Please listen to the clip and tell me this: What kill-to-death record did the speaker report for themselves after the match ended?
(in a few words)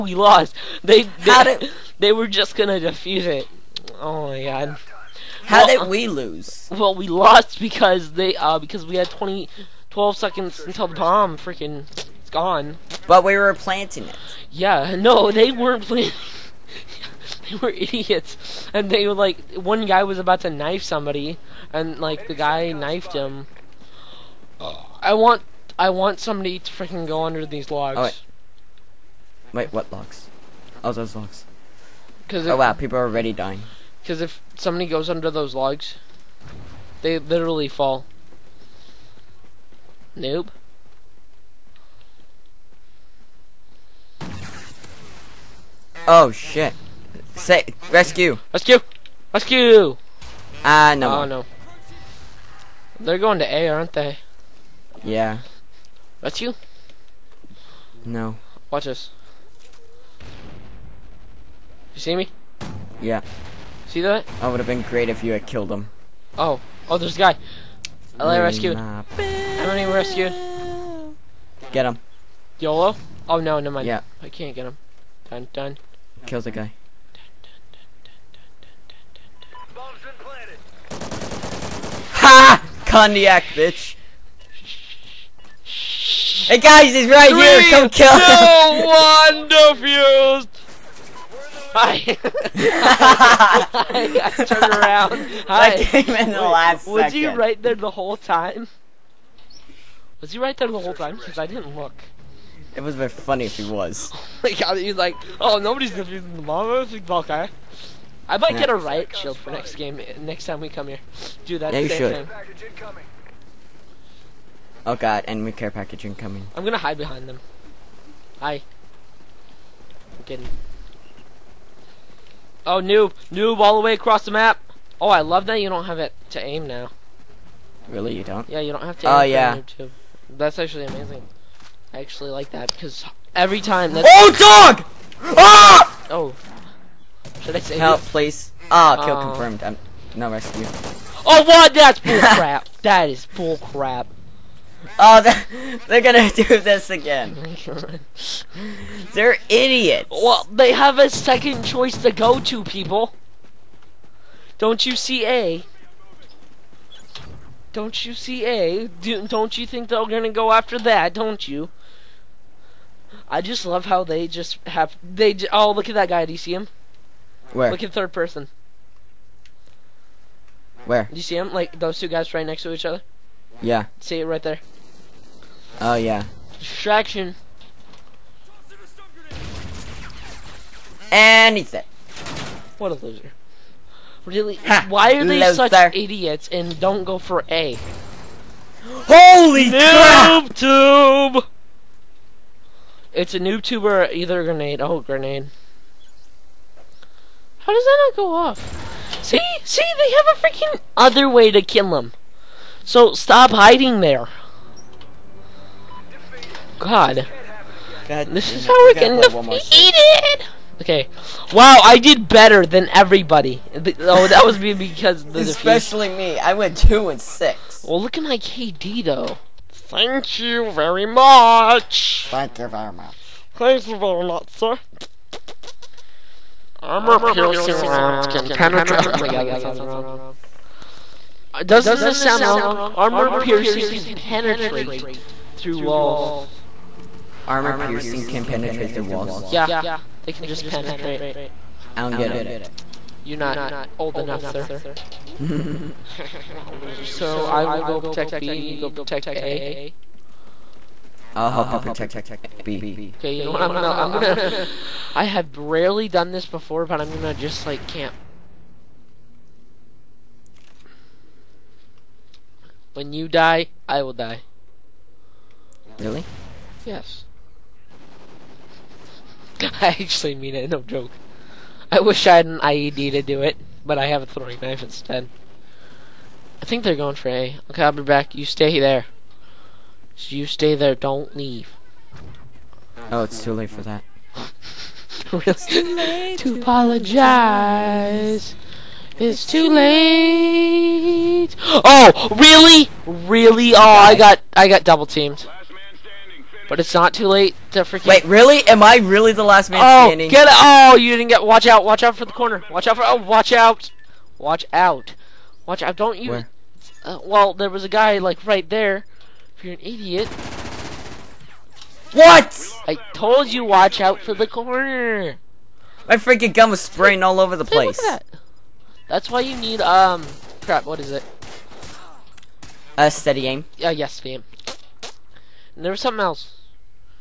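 2 and 6.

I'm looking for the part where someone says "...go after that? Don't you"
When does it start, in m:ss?
2:40.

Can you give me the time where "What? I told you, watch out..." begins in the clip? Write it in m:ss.
5:12.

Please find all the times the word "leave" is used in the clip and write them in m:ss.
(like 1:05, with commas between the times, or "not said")
4:41.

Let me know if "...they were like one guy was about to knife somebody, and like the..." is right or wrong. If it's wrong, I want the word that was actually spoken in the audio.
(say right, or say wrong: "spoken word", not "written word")
right.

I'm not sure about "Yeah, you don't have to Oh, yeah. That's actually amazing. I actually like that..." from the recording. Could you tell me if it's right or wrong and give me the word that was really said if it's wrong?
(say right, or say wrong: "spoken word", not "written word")
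right.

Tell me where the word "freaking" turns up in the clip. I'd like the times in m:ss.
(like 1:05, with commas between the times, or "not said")
0:11, 0:26, 3:20, 4:57, 5:16.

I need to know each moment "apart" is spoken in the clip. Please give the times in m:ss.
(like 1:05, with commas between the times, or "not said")
not said.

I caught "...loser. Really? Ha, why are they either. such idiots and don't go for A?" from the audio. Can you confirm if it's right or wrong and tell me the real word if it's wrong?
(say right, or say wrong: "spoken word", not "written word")
wrong: "loser", not "either".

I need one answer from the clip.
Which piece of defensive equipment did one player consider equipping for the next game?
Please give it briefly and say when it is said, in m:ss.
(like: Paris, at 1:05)
riot shield, at 1:48.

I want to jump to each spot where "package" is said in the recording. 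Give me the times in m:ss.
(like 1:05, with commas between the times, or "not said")
1:55.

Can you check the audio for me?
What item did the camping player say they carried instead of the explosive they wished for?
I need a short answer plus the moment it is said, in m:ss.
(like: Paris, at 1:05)
throwing knife, at 4:34.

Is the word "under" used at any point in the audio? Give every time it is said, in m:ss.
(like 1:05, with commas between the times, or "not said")
0:27, 0:35.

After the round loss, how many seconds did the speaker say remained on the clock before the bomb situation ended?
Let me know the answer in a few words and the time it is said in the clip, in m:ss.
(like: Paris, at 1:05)
12, at 0:09.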